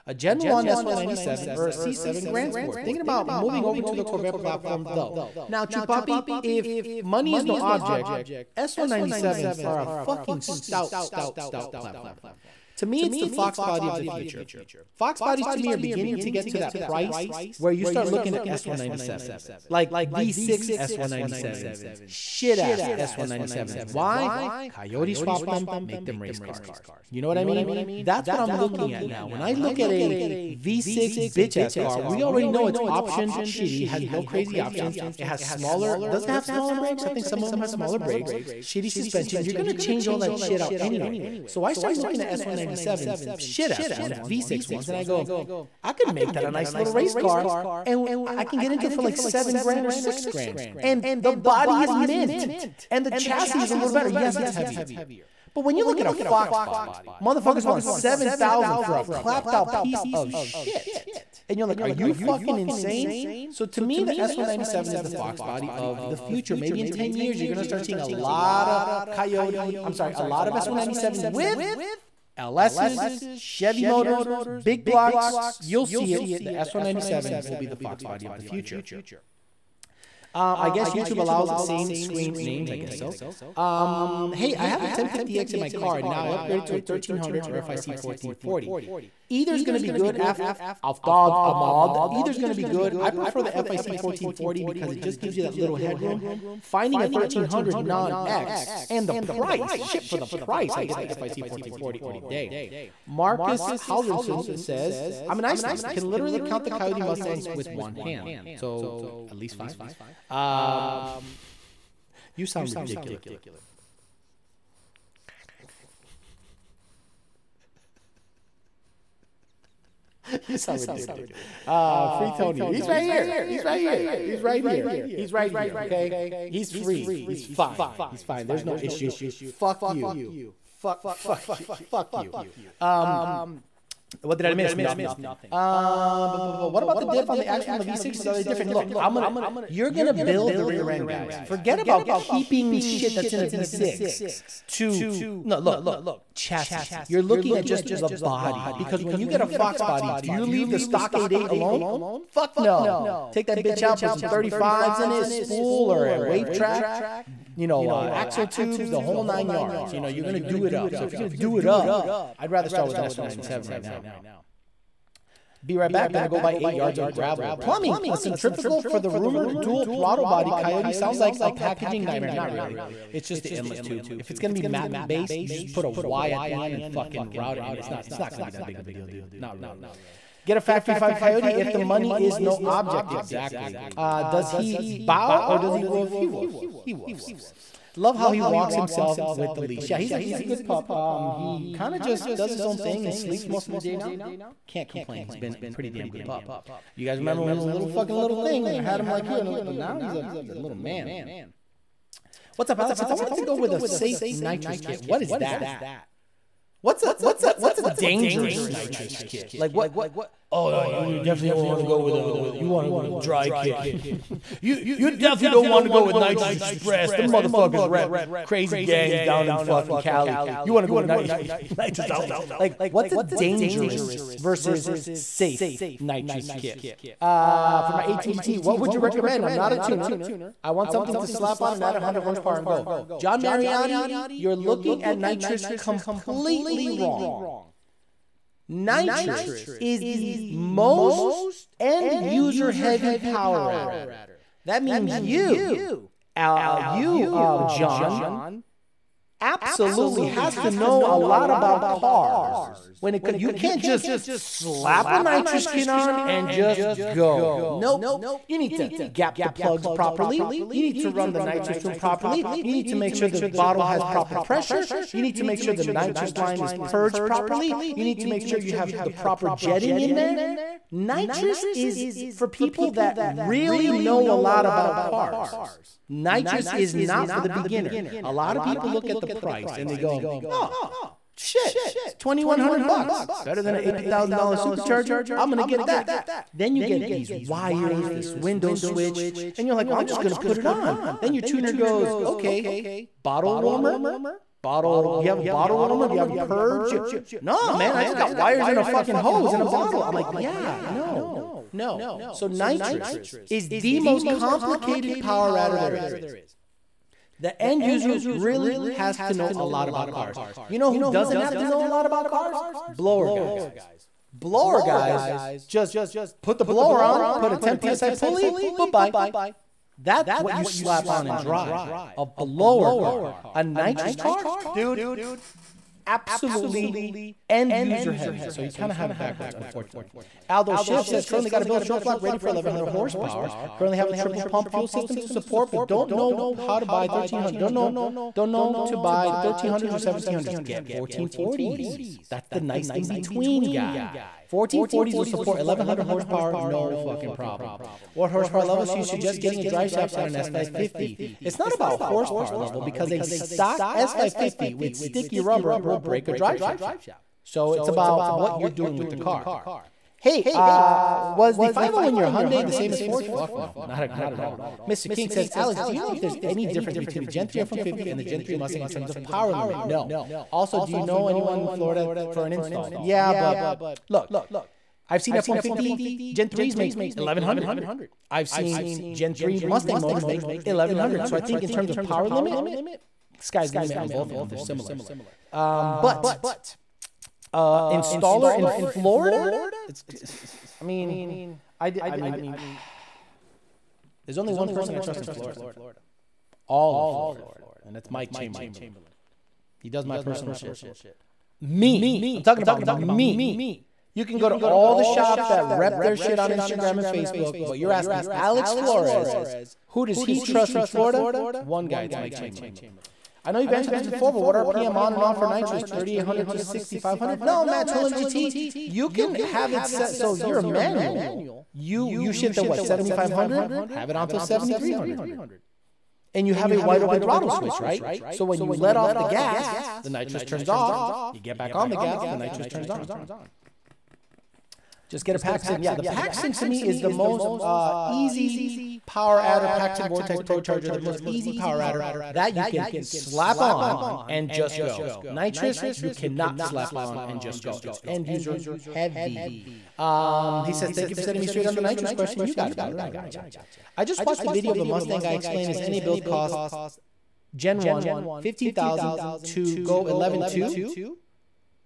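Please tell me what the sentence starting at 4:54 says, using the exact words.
Bottle, do you have a bottle warmer?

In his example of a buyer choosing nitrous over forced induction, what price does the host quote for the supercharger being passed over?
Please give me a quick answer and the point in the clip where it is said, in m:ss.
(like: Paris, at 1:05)
$8,000, at 4:43.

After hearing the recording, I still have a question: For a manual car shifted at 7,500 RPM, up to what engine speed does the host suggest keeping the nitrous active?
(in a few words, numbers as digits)
7,300.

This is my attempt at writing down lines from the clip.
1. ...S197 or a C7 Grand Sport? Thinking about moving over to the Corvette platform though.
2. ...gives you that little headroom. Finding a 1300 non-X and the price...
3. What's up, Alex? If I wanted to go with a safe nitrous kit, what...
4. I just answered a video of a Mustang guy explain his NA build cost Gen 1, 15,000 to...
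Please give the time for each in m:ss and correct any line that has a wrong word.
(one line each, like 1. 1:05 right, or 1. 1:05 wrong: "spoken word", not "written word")
1. 0:00 right
2. 1:35 right
3. 3:22 right
4. 7:33 wrong: "watched", not "answered".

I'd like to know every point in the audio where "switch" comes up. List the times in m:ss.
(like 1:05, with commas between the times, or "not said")
4:48, 7:07.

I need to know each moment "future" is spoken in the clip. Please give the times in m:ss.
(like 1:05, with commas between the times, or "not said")
0:14, 1:06, 1:18.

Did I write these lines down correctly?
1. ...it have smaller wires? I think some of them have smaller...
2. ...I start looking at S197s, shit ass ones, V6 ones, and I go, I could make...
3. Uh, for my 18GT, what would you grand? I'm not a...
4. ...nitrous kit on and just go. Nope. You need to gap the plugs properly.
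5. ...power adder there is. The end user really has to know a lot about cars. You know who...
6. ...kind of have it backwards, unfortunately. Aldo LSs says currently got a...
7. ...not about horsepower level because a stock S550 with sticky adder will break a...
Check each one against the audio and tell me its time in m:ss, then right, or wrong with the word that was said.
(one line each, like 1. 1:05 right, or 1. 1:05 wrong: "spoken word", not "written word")
1. 0:36 wrong: "brakes", not "wires"
2. 0:41 right
3. 3:47 wrong: "recommend", not "grand"
4. 4:15 right
5. 5:05 right
6. 5:28 wrong: "Schiff", not "LSs"
7. 5:51 wrong: "rubber", not "adder".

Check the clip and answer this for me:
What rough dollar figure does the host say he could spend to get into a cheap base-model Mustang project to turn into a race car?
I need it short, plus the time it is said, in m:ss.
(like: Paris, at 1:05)
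7,000, at 0:49.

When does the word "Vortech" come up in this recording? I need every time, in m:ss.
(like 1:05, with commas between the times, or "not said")
7:20.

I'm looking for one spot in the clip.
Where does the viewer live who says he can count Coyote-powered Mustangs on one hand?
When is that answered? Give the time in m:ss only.
1:45.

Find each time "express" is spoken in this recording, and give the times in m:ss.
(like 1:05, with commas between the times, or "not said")
3:36.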